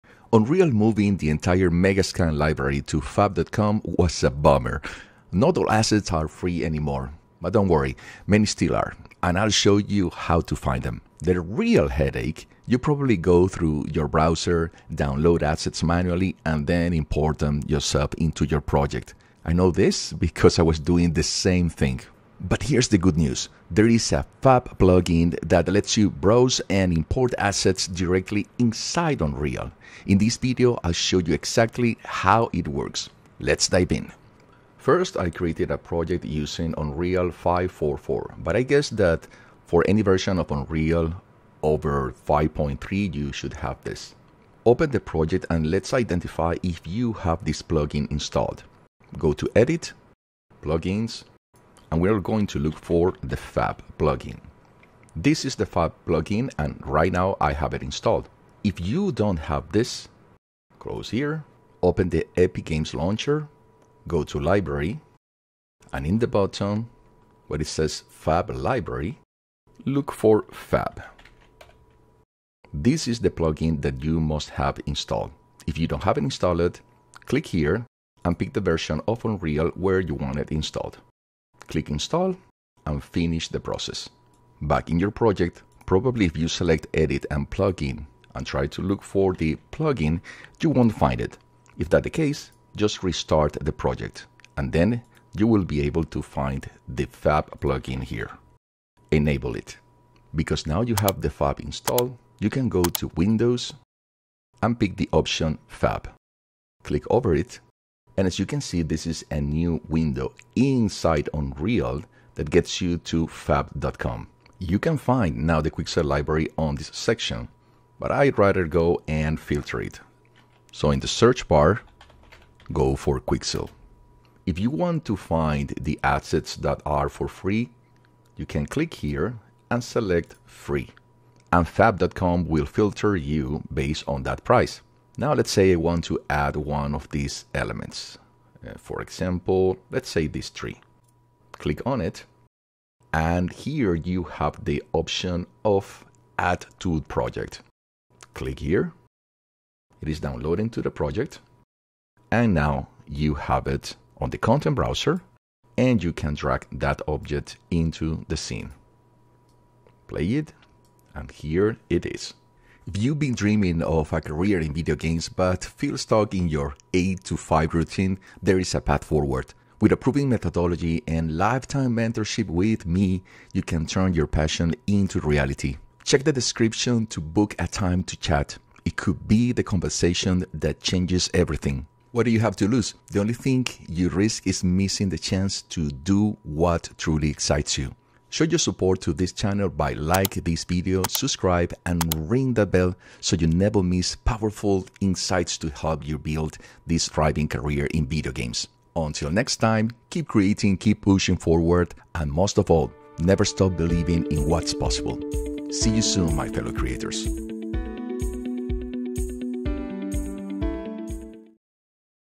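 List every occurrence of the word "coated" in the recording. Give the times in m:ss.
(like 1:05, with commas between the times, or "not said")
not said.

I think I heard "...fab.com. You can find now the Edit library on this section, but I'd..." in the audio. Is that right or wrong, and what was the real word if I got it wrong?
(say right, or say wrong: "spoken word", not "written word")
wrong: "Quixel", not "Edit".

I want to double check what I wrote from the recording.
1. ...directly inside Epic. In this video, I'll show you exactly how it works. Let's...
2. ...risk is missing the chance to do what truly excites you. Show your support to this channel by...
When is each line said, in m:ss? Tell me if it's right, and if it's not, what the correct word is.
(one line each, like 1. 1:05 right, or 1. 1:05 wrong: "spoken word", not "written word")
1. 0:27 wrong: "Unreal", not "Epic"
2. 3:04 right.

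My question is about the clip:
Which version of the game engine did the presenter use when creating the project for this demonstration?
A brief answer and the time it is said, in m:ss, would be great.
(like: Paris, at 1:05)
Unreal 5.4.4, at 0:36.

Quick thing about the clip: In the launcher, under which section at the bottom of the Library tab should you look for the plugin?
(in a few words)
Fab Library.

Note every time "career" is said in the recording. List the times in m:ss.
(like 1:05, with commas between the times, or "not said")
2:44, 3:17.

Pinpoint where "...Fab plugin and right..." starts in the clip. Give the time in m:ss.
0:55.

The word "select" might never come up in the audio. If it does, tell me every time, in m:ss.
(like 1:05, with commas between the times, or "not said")
1:26, 2:09.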